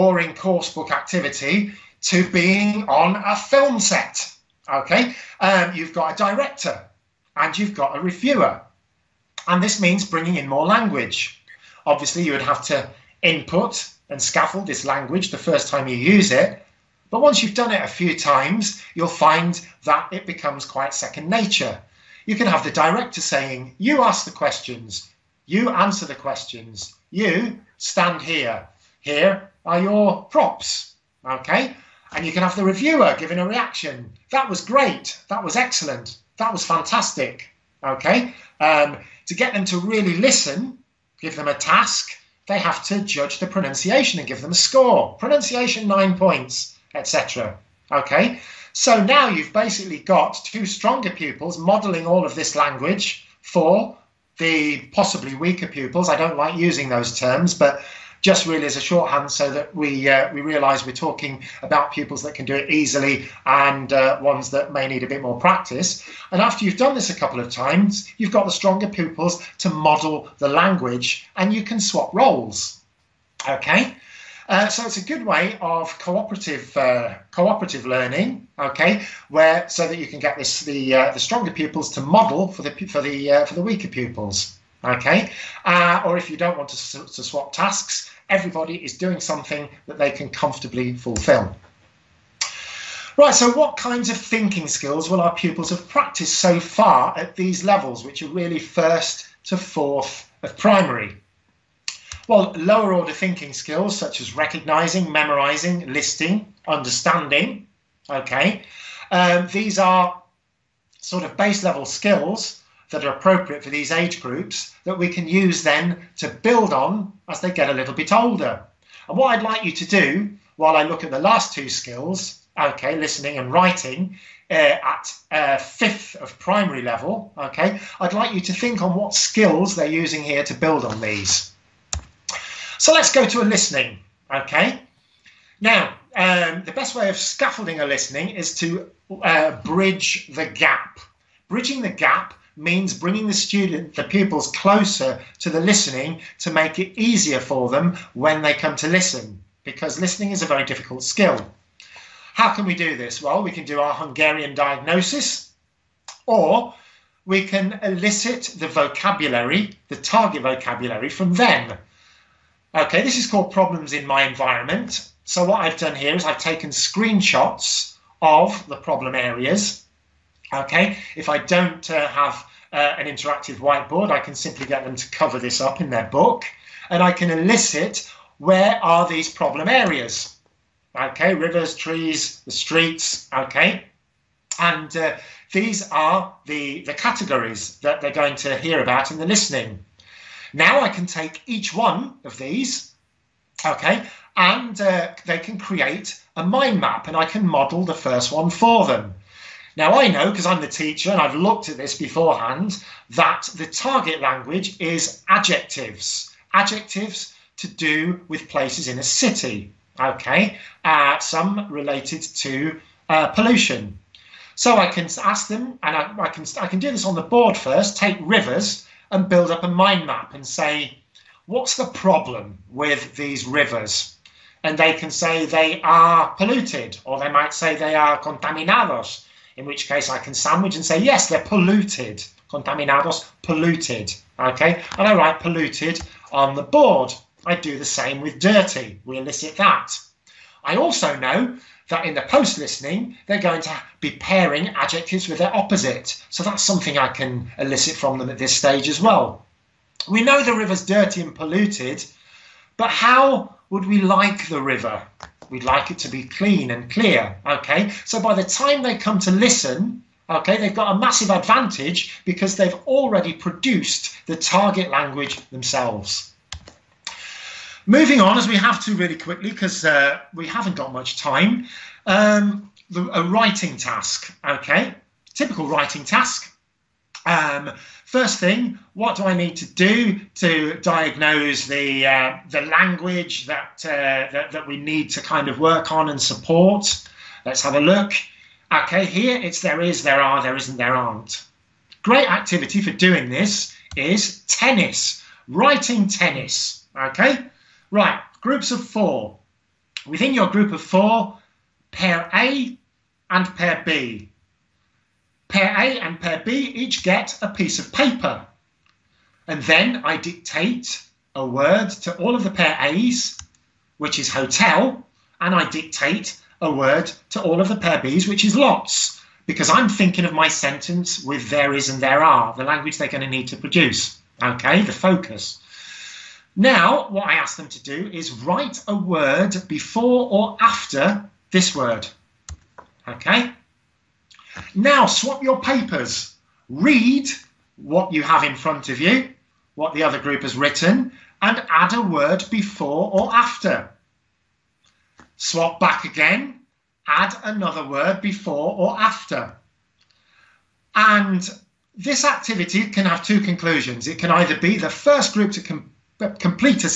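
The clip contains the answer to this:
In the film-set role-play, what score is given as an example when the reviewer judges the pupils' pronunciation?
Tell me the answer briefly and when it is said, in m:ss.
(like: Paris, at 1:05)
9 points, at 0:45.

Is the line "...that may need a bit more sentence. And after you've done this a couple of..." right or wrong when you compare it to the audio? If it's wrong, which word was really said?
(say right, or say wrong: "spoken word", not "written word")
wrong: "practice", not "sentence".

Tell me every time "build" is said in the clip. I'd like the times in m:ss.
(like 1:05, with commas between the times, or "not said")
1:56, 2:10, 3:39.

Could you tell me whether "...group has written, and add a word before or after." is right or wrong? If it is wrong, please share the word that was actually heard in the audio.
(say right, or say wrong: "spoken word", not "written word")
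right.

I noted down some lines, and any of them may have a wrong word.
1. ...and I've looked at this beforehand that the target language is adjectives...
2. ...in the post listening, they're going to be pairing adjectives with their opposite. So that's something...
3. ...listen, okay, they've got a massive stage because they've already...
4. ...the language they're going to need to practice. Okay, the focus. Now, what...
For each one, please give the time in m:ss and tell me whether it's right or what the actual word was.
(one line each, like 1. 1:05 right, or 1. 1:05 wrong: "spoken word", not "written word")
1. 3:21 right
2. 4:02 right
3. 4:19 wrong: "advantage", not "stage"
4. 5:22 wrong: "produce", not "practice".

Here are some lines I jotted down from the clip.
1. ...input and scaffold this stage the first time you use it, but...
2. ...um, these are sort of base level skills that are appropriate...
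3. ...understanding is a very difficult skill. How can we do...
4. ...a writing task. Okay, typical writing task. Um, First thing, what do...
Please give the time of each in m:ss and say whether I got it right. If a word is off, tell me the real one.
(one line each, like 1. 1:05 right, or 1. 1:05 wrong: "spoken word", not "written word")
1. 0:13 wrong: "language", not "stage"
2. 1:49 right
3. 2:30 wrong: "listening", not "understanding"
4. 4:33 right.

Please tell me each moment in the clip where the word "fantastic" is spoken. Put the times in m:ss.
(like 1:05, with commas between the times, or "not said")
0:36.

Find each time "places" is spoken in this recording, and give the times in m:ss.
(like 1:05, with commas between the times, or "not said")
3:28.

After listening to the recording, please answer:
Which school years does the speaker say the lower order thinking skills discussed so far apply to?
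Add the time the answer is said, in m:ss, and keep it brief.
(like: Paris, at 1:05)
first to fourth of primary, at 1:38.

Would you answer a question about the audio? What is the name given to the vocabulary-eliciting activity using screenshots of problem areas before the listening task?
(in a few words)
problems in my environment.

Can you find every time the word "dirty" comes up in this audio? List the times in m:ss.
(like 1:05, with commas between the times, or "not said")
3:58, 4:10.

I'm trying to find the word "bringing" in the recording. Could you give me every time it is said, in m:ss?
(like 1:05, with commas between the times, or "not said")
0:10, 2:22.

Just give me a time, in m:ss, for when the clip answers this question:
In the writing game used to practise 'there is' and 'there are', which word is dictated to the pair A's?
5:14.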